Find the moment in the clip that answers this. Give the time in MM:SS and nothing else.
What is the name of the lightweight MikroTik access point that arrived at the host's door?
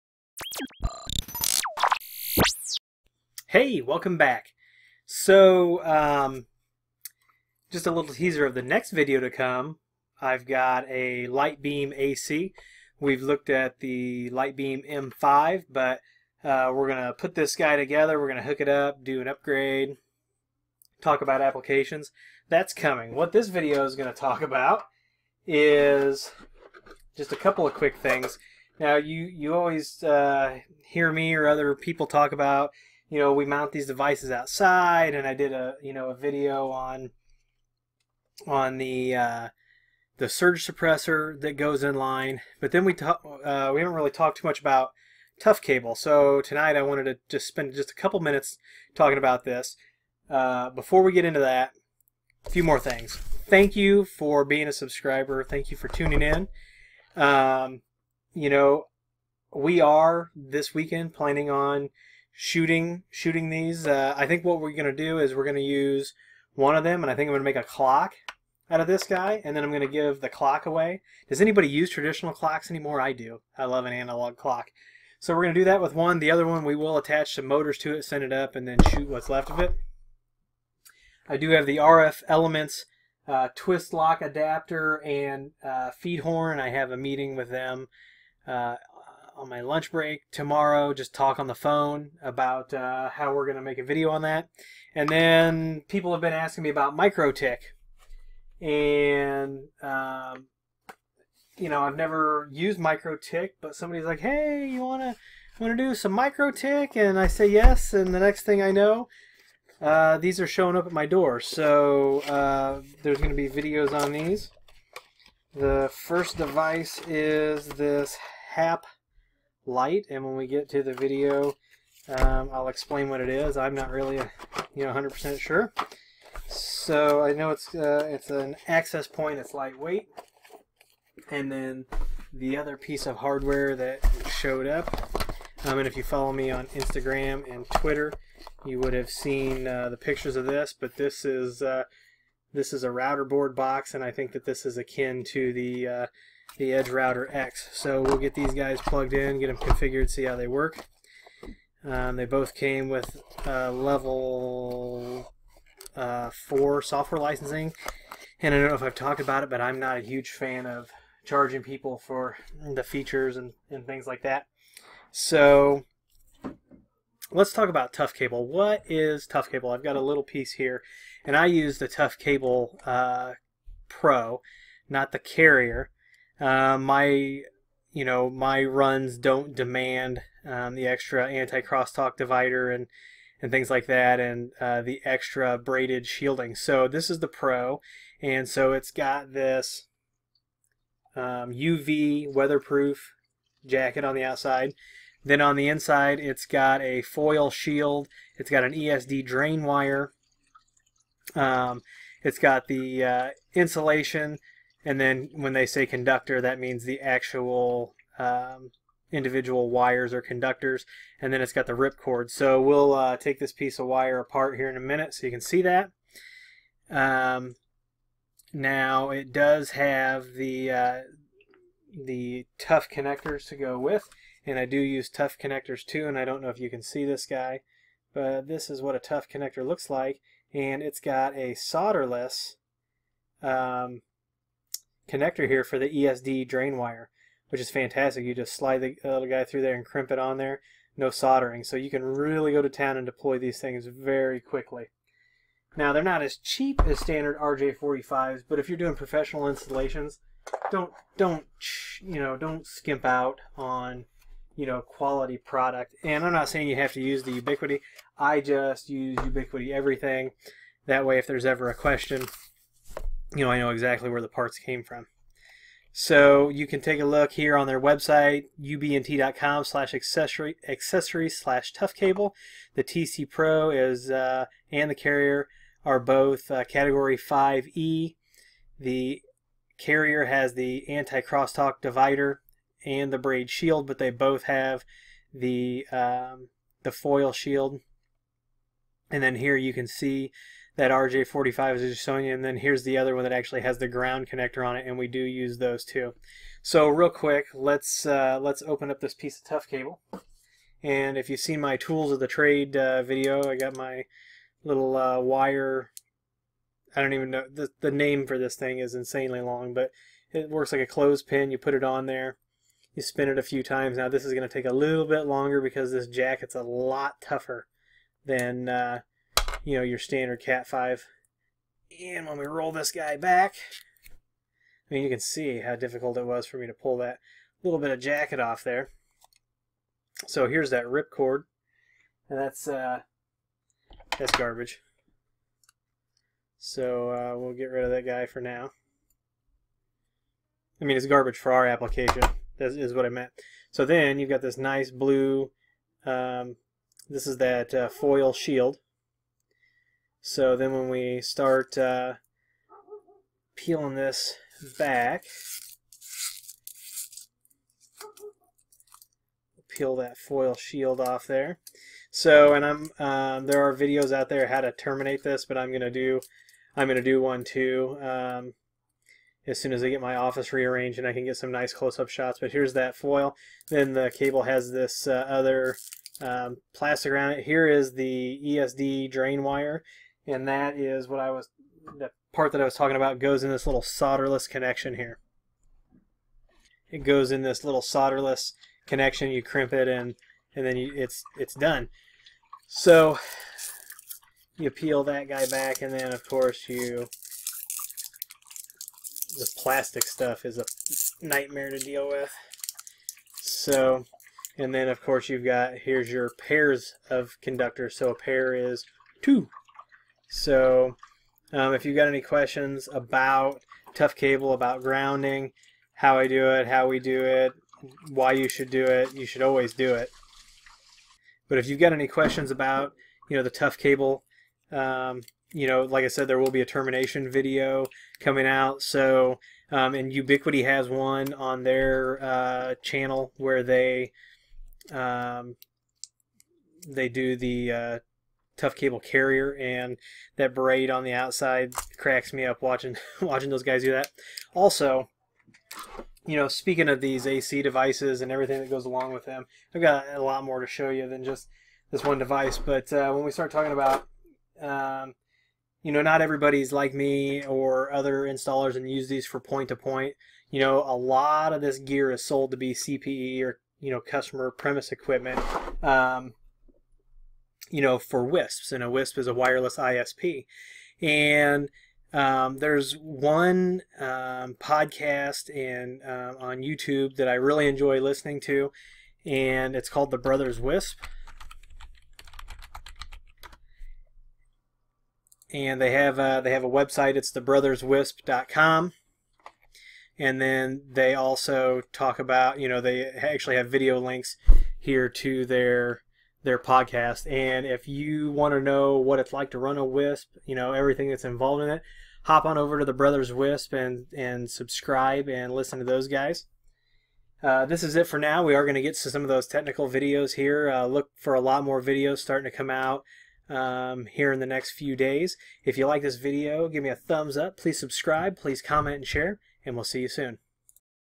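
01:58.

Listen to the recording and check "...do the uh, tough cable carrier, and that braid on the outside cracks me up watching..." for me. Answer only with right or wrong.
right.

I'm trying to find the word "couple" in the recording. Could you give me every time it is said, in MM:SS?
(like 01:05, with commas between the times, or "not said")
00:27, 00:47.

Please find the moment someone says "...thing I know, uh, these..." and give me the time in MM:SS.
01:48.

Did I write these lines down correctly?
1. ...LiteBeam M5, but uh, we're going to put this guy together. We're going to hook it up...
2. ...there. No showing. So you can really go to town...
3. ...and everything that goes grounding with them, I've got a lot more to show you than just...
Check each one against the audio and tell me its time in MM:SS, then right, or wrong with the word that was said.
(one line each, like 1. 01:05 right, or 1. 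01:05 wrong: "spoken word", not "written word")
1. 00:14 right
2. 04:00 wrong: "soldering", not "showing"
3. 07:28 wrong: "along", not "grounding".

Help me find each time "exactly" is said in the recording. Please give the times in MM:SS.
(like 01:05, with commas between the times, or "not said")
04:23.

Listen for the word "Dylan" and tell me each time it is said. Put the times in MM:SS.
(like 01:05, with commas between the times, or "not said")
not said.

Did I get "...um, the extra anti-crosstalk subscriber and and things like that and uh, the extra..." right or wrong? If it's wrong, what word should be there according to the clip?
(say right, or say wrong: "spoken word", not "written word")
wrong: "divider", not "subscriber".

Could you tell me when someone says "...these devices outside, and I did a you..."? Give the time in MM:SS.
00:33.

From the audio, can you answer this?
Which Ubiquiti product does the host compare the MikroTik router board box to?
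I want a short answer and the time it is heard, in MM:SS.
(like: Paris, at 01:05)
Edge Router X, at 02:26.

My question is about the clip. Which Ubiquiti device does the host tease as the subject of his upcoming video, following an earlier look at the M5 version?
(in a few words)
LiteBeam AC.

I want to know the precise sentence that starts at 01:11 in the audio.
Does anybody use traditional clocks anymore?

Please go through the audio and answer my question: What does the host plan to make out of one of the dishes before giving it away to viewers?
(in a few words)
a clock.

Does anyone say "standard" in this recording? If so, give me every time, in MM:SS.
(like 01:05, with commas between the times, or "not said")
04:06, 05:19.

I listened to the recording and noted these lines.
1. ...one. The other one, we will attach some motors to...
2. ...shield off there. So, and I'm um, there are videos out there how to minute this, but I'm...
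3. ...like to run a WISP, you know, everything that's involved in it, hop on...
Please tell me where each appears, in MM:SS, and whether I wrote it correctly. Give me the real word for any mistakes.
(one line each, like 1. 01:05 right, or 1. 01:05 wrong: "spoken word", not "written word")
1. 01:15 right
2. 06:00 wrong: "terminate", not "minute"
3. 08:19 right.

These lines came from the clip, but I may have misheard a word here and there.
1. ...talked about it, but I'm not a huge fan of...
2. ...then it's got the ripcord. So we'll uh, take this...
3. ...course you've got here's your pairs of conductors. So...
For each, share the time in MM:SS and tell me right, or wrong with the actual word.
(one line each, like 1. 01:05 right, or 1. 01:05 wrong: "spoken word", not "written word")
1. 02:38 right
2. 03:31 right
3. 06:45 right.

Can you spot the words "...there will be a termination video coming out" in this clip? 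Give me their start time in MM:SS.
07:06.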